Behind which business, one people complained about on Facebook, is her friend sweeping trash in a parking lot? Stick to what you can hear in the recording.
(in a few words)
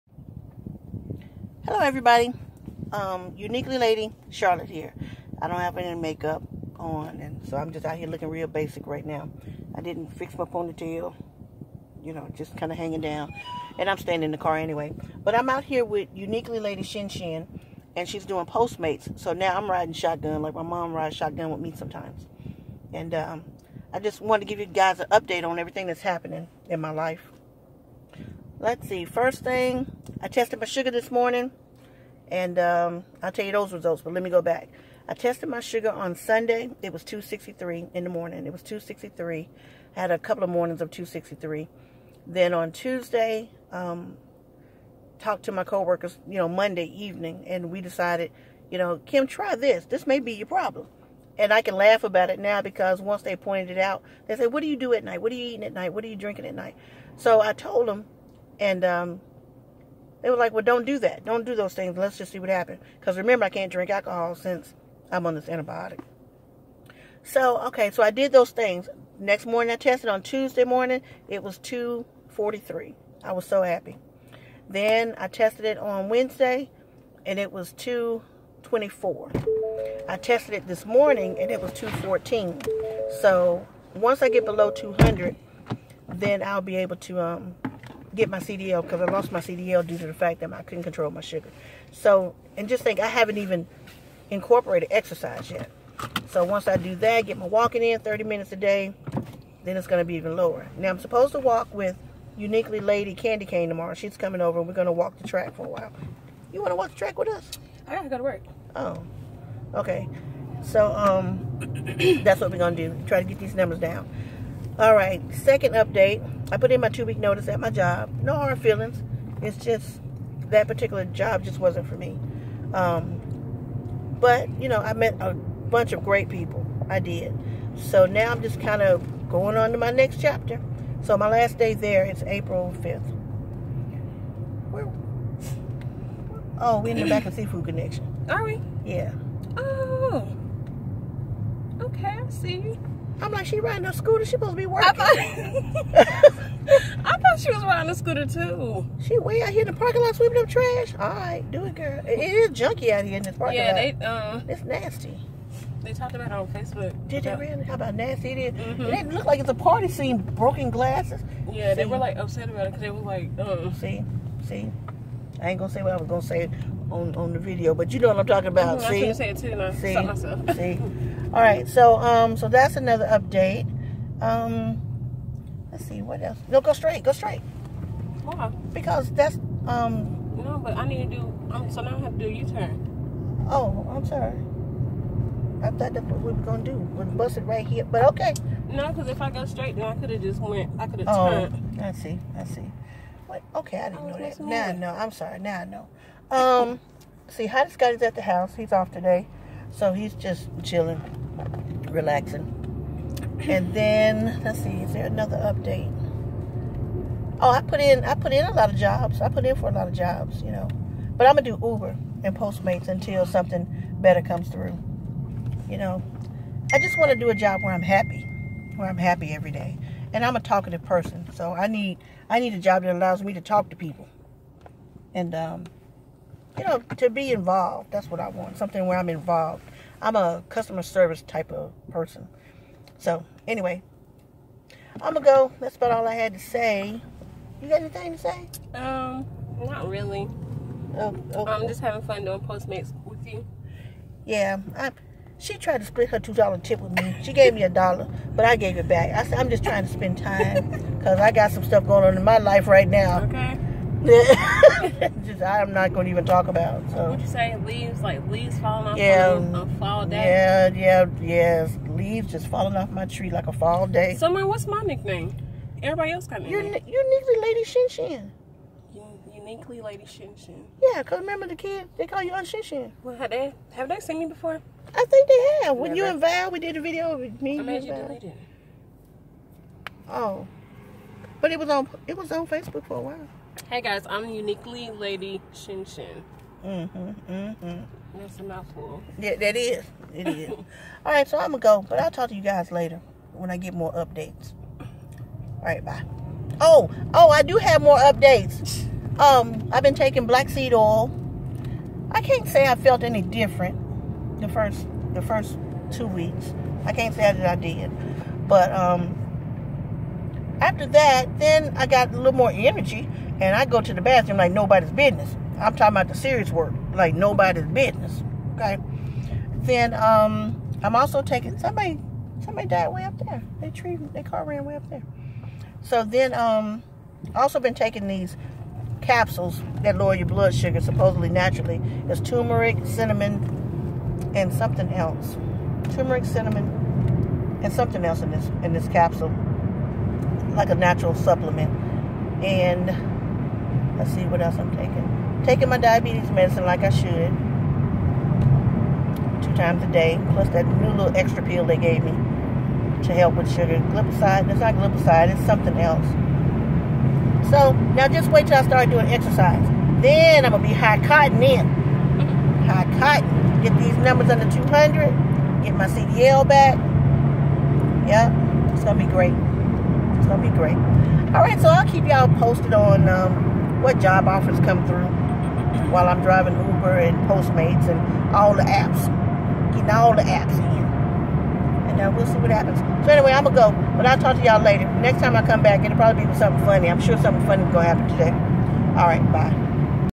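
Seafood Connection.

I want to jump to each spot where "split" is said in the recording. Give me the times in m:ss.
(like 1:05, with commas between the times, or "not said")
4:05.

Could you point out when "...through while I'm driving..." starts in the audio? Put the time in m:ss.
6:14.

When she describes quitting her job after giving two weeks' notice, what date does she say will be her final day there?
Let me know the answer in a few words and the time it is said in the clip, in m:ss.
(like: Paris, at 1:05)
April 5th, at 2:12.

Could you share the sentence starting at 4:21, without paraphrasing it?
Leaves just falling off my tree like a fall day.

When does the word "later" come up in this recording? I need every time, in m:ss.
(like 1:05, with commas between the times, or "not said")
4:52, 6:24.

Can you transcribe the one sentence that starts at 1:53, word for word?
Try to get these numbers down.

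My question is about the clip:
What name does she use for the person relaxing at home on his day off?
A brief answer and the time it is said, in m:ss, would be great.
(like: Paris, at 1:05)
Hottest God, at 3:17.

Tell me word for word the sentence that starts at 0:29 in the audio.
First thing, I tested my sugar this morning.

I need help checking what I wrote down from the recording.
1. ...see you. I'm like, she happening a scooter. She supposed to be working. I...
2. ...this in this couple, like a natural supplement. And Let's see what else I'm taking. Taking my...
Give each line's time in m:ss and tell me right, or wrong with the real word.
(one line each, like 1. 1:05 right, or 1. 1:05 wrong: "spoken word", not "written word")
1. 2:22 wrong: "riding", not "happening"
2. 5:38 wrong: "capsule", not "couple".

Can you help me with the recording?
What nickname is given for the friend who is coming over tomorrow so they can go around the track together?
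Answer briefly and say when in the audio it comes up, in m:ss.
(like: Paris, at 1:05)
Uniquely Lady Candy Cane, at 1:42.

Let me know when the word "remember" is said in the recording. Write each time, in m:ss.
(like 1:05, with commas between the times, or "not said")
1:03, 4:31.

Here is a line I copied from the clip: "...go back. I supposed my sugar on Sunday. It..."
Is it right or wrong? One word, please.
wrong.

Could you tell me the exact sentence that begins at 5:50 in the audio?
Plus that new little extra pill they gave me to help with sugar.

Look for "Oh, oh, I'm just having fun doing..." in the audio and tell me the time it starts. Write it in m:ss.
4:00.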